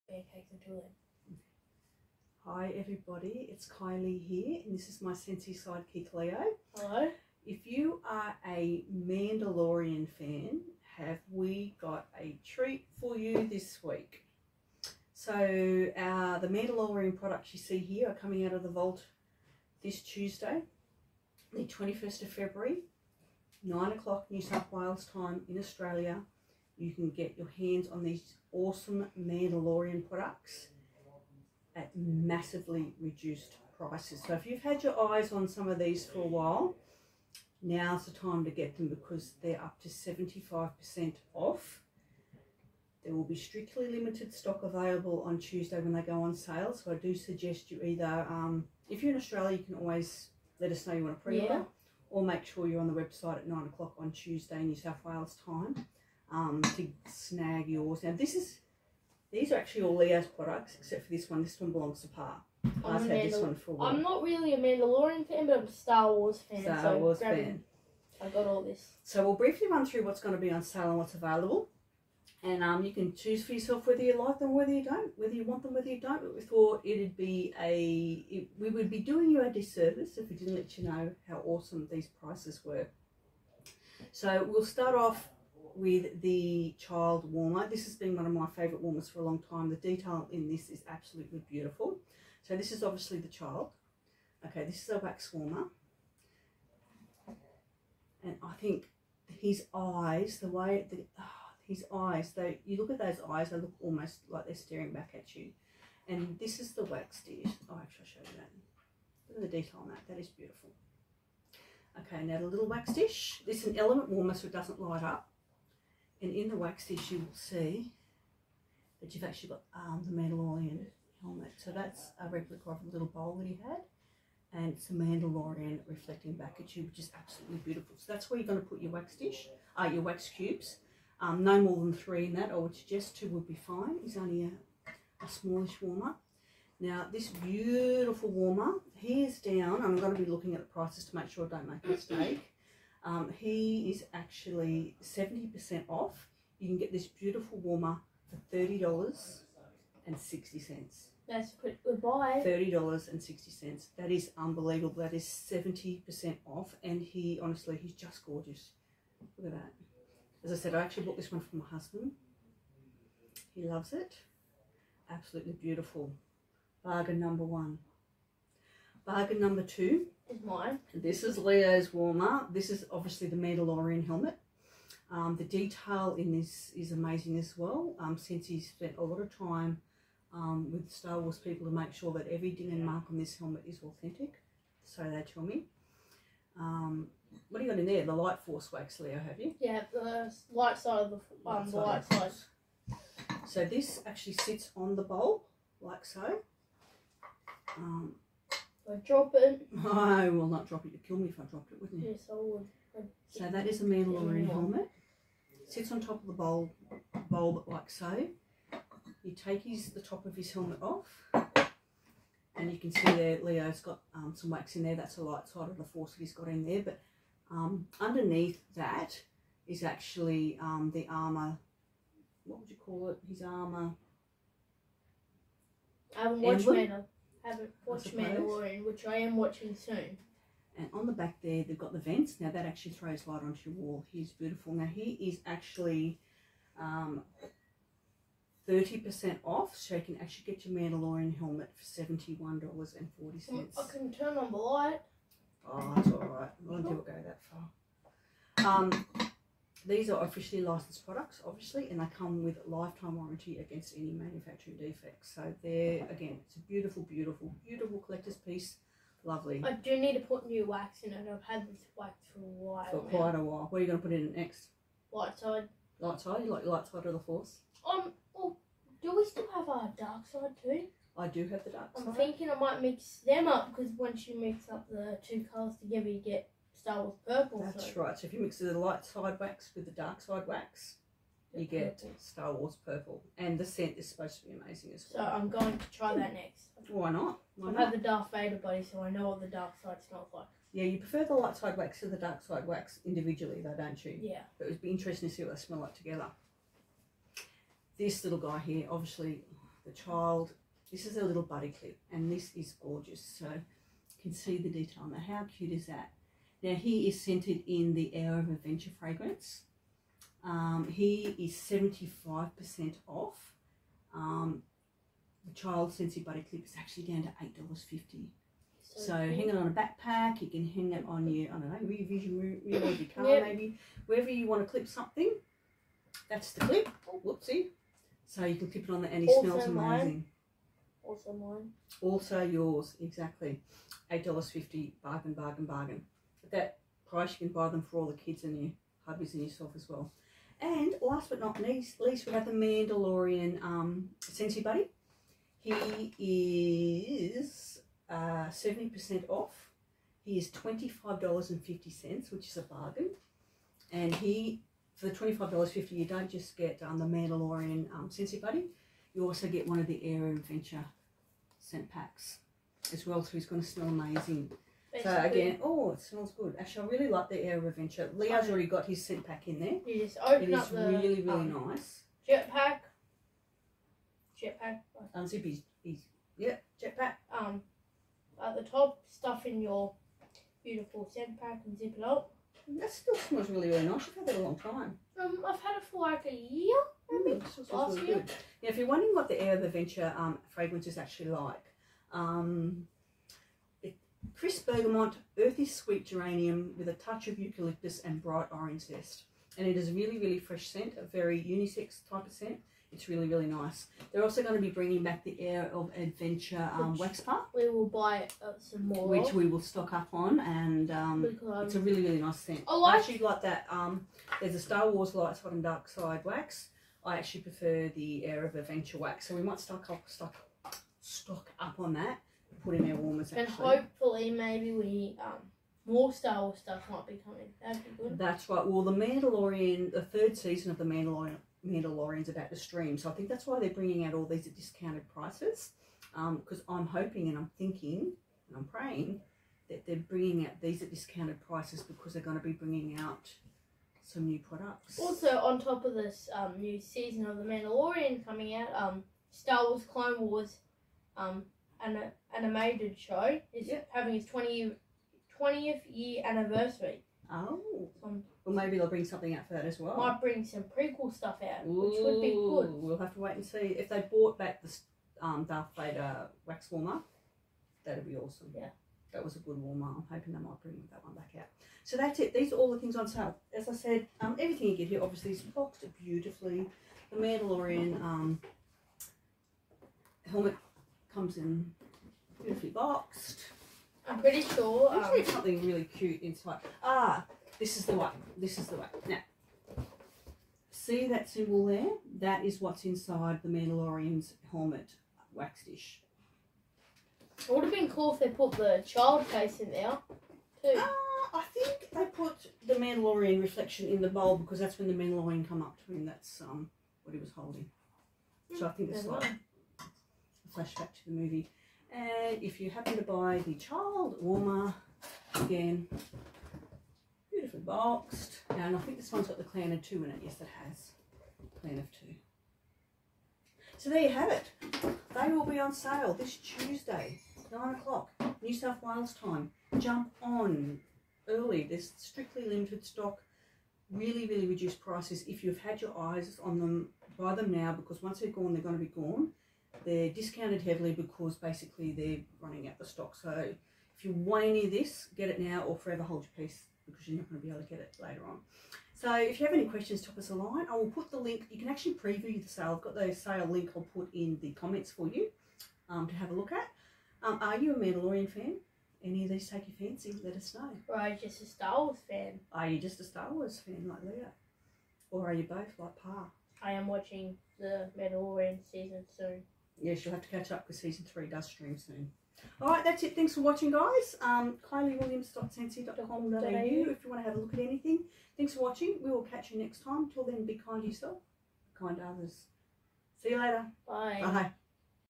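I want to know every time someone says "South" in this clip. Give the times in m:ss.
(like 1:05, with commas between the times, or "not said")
0:24, 0:54, 8:48.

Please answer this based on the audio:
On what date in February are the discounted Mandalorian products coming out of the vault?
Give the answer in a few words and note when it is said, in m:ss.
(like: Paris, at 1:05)
21st of February, at 0:21.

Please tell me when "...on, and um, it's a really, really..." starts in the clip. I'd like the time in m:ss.
6:50.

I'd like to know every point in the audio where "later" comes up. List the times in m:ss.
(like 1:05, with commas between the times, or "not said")
9:08, 9:43.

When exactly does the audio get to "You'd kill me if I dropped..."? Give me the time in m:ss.
3:20.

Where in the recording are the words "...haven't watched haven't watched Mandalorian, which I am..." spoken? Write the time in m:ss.
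3:46.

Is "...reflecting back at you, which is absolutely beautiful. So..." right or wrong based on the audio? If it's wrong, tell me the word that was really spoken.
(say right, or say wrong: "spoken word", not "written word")
right.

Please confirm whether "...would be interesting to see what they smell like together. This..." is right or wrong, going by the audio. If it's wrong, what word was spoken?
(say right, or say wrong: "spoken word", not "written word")
right.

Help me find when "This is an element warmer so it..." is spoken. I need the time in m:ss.
1:53.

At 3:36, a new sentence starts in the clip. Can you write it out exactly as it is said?
But um, underneath that is actually um, the armor.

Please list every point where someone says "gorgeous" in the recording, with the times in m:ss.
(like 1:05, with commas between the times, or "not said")
2:38, 5:02.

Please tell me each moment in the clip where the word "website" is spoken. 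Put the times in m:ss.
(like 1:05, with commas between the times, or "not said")
0:52.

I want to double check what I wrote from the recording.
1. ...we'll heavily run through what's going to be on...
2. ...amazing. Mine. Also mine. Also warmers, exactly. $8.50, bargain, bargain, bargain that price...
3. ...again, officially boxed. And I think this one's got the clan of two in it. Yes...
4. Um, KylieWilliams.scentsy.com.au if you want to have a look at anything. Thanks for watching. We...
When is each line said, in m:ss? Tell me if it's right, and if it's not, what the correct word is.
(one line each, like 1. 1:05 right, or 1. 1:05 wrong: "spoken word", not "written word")
1. 1:09 wrong: "briefly", not "heavily"
2. 5:29 wrong: "yours", not "warmers"
3. 8:35 wrong: "beautifully", not "officially"
4. 9:34 right.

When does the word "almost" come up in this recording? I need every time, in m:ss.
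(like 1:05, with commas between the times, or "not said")
1:43.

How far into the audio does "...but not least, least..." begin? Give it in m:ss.
5:41.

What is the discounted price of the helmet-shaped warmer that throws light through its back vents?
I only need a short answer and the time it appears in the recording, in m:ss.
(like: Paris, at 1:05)
$71.40, at 4:01.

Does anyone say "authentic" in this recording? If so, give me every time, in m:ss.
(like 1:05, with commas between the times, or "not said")
3:03.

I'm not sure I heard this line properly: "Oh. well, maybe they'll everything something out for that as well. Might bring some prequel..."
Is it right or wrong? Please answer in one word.
wrong.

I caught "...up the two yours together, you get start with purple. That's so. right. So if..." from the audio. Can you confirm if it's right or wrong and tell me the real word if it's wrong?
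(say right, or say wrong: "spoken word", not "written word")
wrong: "colours", not "yours".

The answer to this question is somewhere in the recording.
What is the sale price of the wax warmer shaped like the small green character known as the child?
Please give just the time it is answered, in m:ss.
2:28.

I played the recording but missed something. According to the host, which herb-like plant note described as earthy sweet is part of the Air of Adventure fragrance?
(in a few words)
Geranium.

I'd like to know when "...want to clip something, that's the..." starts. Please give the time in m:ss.
5:24.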